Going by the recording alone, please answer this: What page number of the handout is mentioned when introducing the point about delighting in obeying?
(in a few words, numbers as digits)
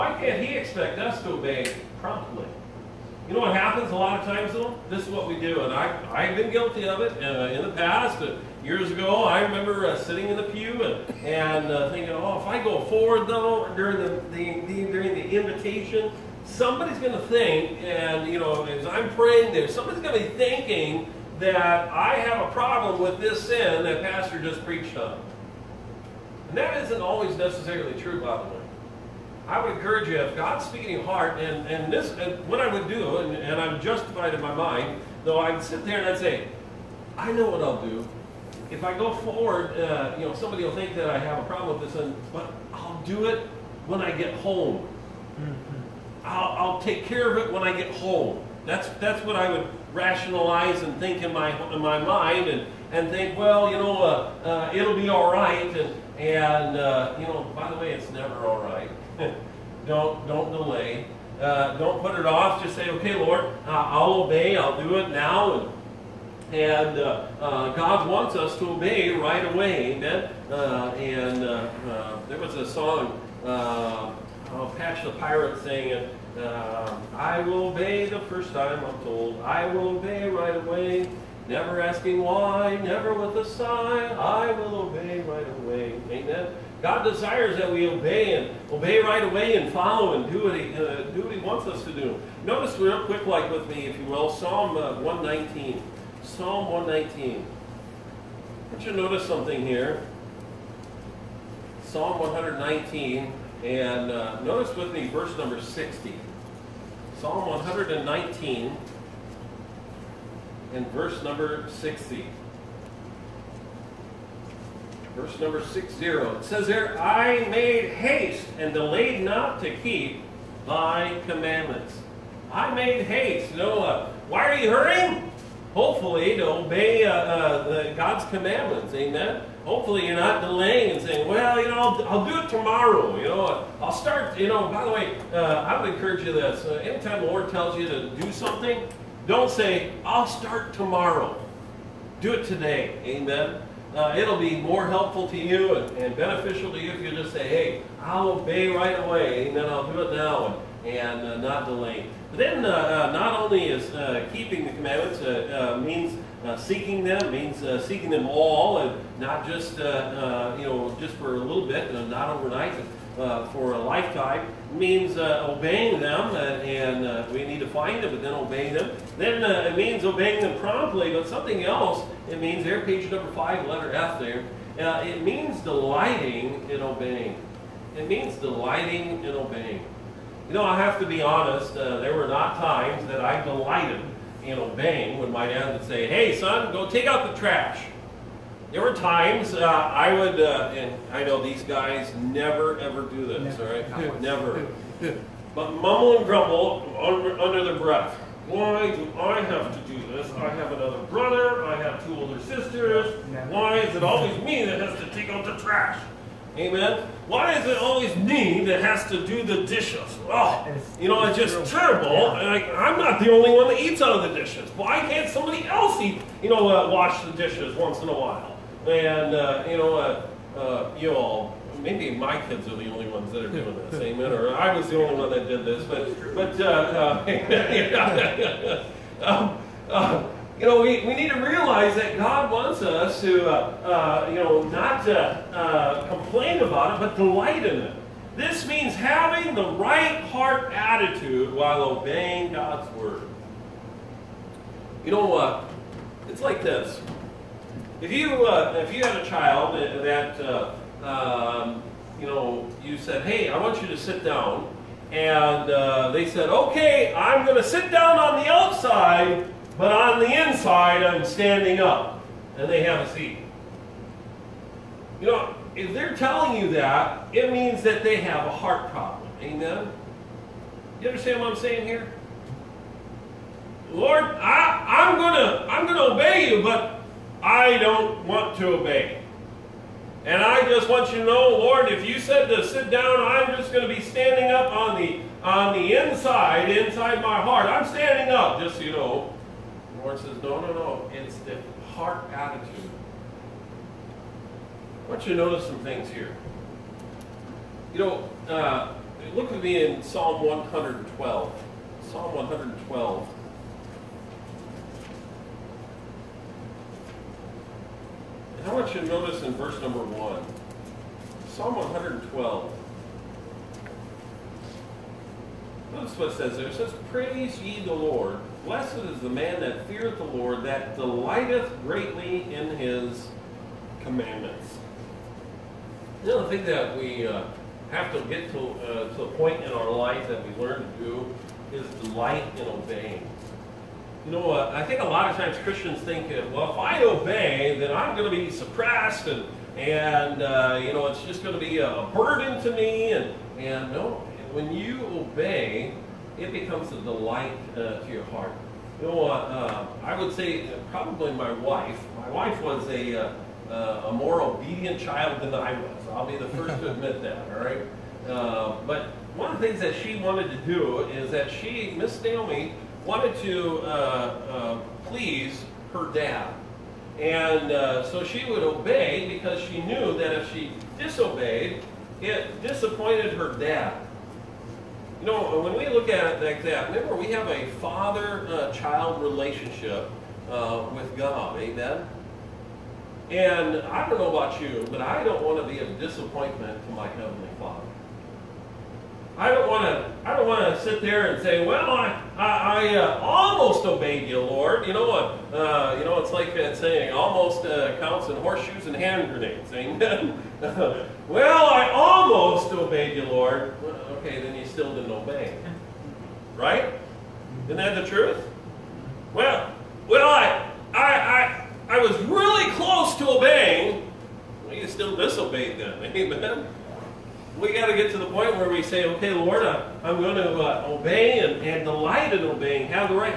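5.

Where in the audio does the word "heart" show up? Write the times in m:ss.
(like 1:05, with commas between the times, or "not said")
0:31, 4:00, 4:28, 4:47, 4:51, 5:48.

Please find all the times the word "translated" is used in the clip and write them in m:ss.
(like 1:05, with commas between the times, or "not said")
not said.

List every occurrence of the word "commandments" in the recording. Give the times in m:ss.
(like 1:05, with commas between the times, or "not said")
2:01, 2:08, 2:34, 5:24.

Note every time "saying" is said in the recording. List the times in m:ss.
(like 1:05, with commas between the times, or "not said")
2:11, 4:31, 6:36.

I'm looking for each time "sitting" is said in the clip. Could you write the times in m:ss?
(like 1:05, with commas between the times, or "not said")
0:09.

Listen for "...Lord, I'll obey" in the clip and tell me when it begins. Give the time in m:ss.
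1:03.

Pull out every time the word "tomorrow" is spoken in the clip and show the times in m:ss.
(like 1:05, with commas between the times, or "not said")
2:12, 2:20.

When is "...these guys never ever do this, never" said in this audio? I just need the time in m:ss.
3:11.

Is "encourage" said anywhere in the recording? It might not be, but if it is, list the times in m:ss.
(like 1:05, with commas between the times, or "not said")
0:29, 2:15.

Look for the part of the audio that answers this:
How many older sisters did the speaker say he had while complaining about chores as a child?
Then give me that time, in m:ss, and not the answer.
3:22.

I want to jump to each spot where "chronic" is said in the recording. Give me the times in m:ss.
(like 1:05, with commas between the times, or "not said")
not said.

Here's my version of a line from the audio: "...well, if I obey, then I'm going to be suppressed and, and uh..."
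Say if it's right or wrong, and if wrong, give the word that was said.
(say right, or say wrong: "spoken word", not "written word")
right.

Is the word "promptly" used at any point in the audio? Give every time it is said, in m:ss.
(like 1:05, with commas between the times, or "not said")
0:01, 2:50.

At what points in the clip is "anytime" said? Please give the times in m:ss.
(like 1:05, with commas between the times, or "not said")
2:16.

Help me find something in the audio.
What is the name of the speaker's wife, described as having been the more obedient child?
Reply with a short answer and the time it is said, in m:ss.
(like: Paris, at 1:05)
Naomi, at 6:01.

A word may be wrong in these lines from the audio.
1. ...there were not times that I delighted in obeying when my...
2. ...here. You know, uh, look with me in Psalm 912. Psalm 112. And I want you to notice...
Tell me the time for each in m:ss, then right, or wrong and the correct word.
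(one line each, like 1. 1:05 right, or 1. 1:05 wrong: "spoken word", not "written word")
1. 3:01 right
2. 4:56 wrong: "112", not "912".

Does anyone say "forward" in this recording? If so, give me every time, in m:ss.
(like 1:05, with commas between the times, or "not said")
0:12, 0:39.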